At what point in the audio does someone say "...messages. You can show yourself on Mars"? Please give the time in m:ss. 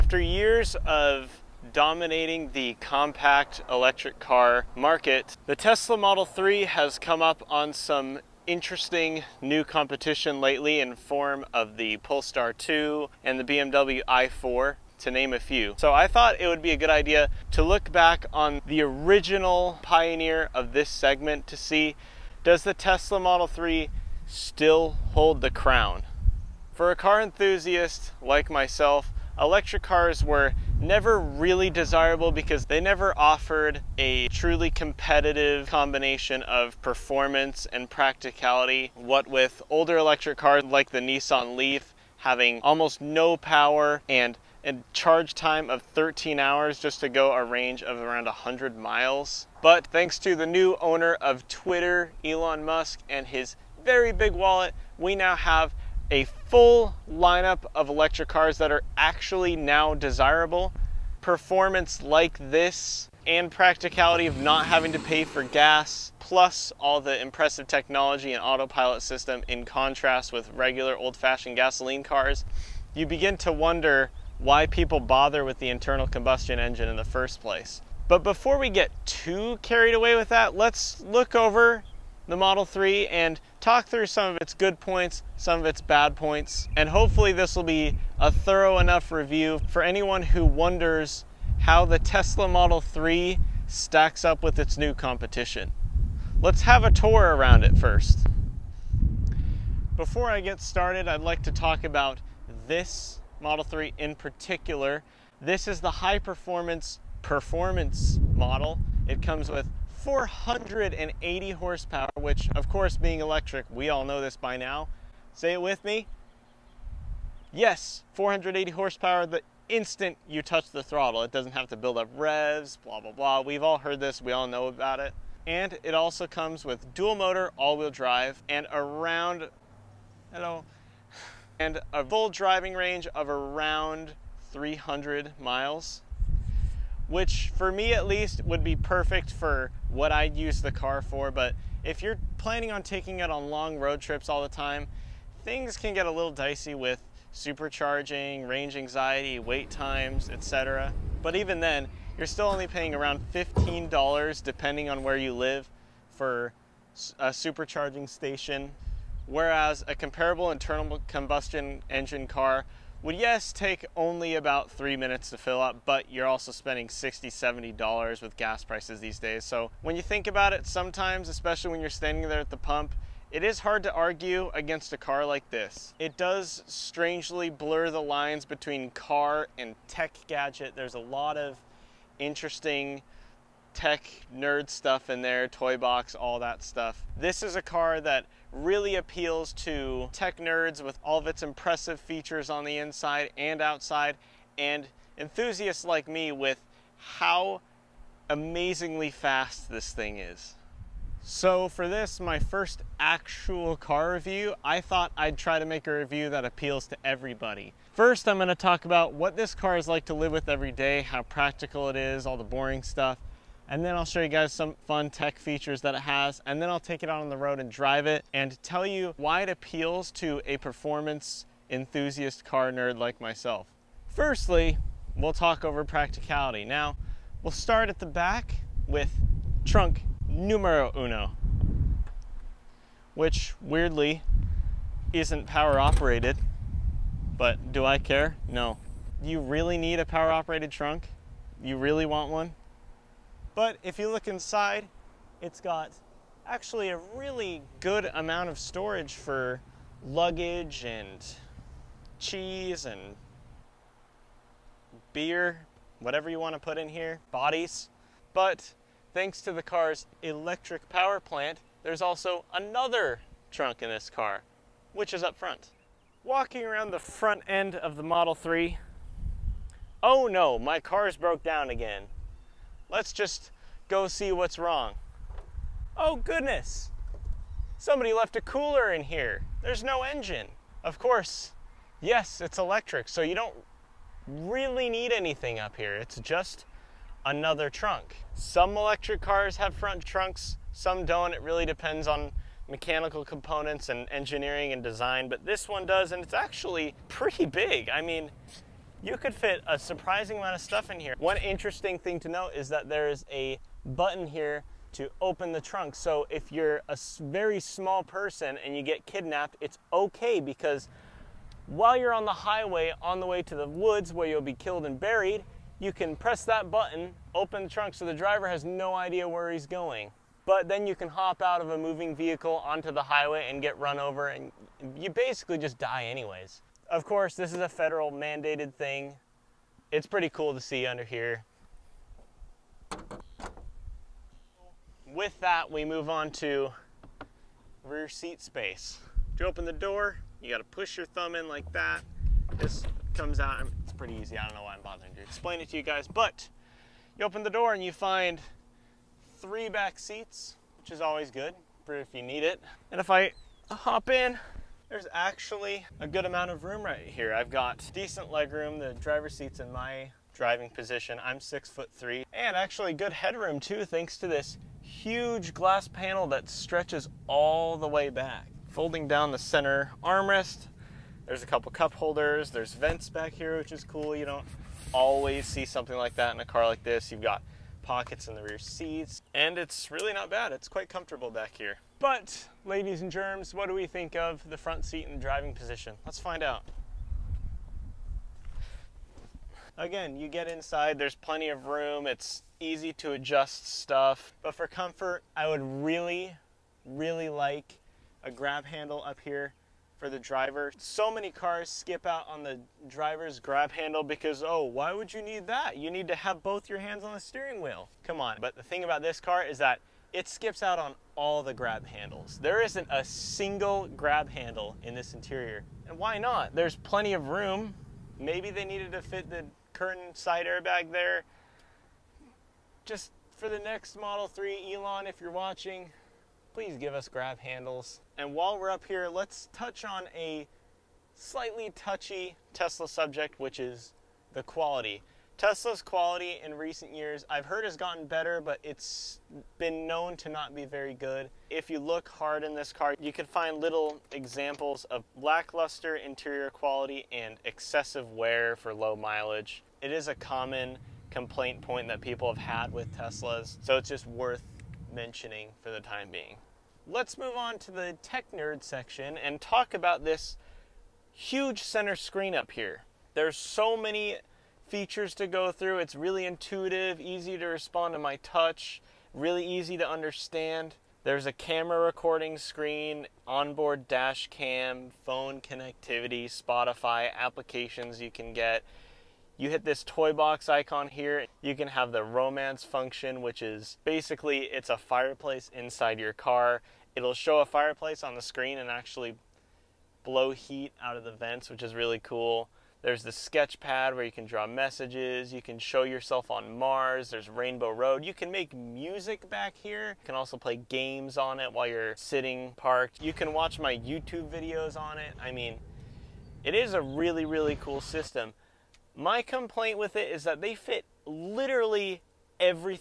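8:14.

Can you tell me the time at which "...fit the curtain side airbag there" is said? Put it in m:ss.
6:59.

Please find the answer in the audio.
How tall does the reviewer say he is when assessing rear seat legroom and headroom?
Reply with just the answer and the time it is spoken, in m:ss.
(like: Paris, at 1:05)
six foot three, at 6:01.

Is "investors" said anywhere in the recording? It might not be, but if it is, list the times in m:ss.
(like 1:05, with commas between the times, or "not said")
not said.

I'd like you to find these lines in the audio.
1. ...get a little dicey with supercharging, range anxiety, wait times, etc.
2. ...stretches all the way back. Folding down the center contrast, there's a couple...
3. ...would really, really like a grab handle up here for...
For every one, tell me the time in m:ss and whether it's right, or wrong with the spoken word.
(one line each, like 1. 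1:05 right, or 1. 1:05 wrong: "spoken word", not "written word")
1. 2:25 right
2. 6:06 wrong: "armrest", not "contrast"
3. 6:35 right.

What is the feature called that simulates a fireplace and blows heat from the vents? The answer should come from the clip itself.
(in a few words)
romance function.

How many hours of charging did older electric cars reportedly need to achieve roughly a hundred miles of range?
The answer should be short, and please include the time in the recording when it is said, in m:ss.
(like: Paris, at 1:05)
13 hours, at 0:45.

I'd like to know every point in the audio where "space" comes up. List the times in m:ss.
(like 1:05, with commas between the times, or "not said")
5:38.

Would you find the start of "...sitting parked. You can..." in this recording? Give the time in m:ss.
8:21.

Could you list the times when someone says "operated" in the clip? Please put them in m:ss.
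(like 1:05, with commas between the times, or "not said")
3:55, 4:00.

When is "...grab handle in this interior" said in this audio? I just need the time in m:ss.
6:53.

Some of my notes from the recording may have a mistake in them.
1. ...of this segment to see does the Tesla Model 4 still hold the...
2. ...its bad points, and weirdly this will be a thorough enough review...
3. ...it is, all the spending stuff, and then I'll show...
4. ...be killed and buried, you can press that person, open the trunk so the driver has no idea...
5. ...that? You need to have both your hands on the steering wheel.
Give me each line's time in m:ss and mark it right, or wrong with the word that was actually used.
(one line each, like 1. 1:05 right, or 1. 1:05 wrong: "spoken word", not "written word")
1. 0:20 wrong: "3", not "4"
2. 1:25 wrong: "hopefully", not "weirdly"
3. 3:31 wrong: "boring", not "spending"
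4. 5:14 wrong: "button", not "person"
5. 6:45 right.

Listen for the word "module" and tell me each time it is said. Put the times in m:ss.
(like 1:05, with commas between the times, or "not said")
not said.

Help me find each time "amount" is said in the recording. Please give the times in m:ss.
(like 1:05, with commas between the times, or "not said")
4:08, 5:00, 5:56.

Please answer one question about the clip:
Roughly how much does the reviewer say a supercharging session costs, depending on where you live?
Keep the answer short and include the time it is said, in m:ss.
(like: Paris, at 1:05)
$15, at 2:33.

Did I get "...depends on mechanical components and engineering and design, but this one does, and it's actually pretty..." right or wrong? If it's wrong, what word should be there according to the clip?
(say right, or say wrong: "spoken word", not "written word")
right.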